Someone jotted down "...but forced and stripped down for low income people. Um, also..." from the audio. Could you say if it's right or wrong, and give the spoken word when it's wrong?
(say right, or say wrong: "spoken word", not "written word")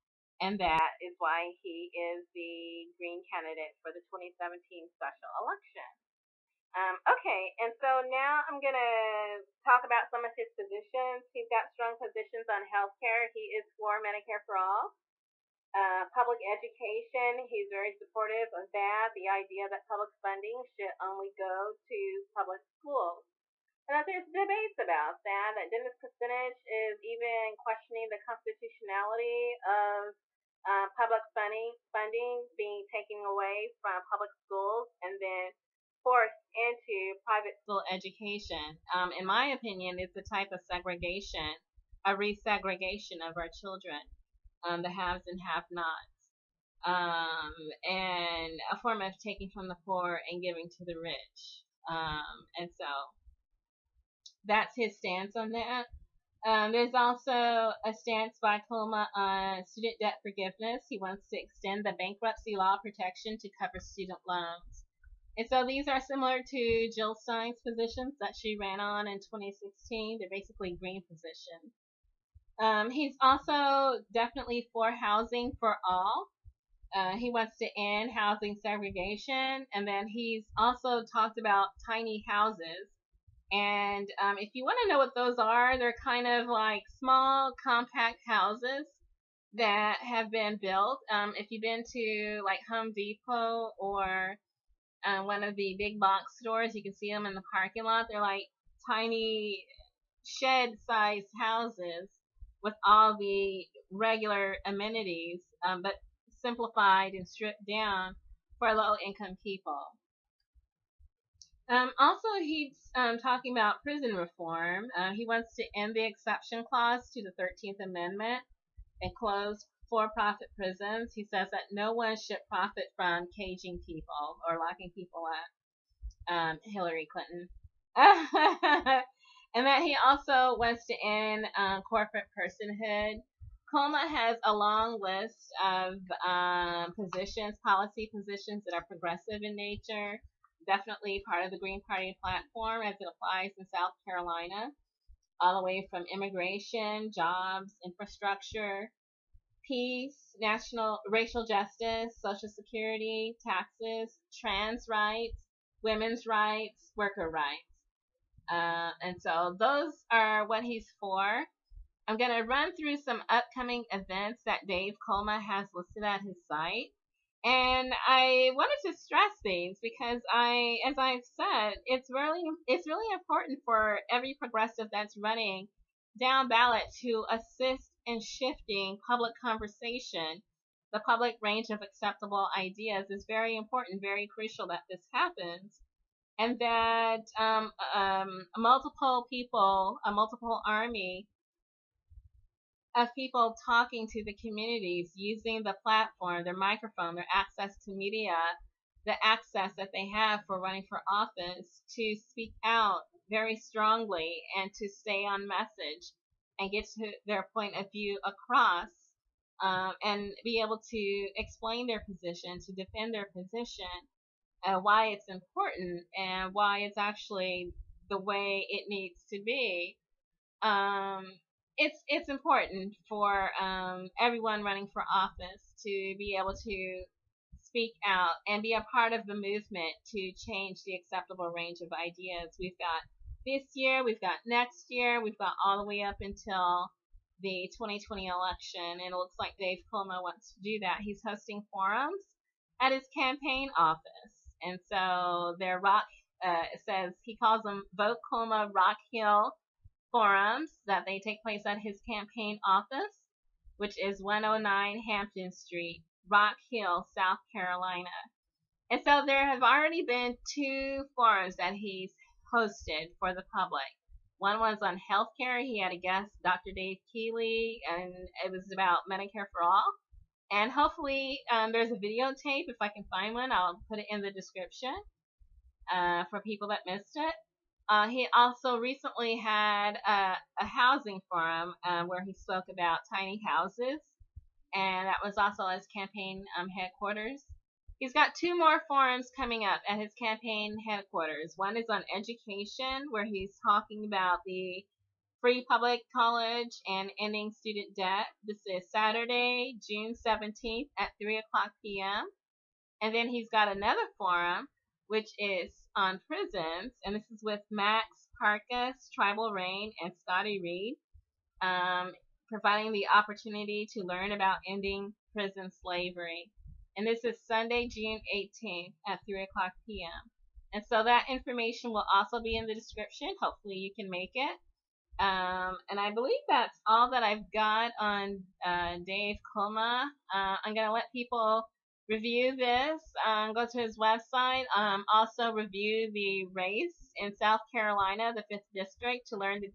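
wrong: "simplified", not "forced".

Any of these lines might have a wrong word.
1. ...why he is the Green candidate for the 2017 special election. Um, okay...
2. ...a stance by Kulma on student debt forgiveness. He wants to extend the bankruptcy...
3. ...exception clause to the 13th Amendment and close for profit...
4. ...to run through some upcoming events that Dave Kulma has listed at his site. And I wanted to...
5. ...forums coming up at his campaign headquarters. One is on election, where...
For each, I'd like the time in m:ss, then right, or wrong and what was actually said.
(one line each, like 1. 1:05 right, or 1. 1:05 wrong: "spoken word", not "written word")
1. 0:01 right
2. 0:57 right
3. 1:56 right
4. 2:42 right
5. 4:48 wrong: "education", not "election".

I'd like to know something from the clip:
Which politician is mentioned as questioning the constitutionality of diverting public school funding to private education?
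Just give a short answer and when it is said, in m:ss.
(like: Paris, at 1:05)
Dennis Kucinich, at 0:25.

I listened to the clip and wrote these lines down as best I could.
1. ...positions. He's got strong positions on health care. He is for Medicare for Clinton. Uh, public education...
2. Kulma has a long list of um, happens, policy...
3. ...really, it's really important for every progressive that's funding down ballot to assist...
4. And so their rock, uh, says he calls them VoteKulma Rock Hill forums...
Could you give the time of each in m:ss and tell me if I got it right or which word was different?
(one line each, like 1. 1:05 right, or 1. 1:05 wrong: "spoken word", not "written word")
1. 0:10 wrong: "All", not "Clinton"
2. 2:13 wrong: "positions", not "happens"
3. 2:52 wrong: "running", not "funding"
4. 4:04 right.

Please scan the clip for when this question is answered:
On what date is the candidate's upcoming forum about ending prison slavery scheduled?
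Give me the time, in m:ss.
5:17.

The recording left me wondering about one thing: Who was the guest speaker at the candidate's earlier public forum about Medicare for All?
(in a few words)
Dr. Dave Keeley.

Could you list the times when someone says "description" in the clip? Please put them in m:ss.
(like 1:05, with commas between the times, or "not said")
4:34, 5:22.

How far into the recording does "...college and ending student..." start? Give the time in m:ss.
4:56.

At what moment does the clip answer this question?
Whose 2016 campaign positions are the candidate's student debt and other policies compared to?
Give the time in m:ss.
1:06.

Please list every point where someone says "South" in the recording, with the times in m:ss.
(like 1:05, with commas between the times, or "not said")
2:23, 4:17, 5:37.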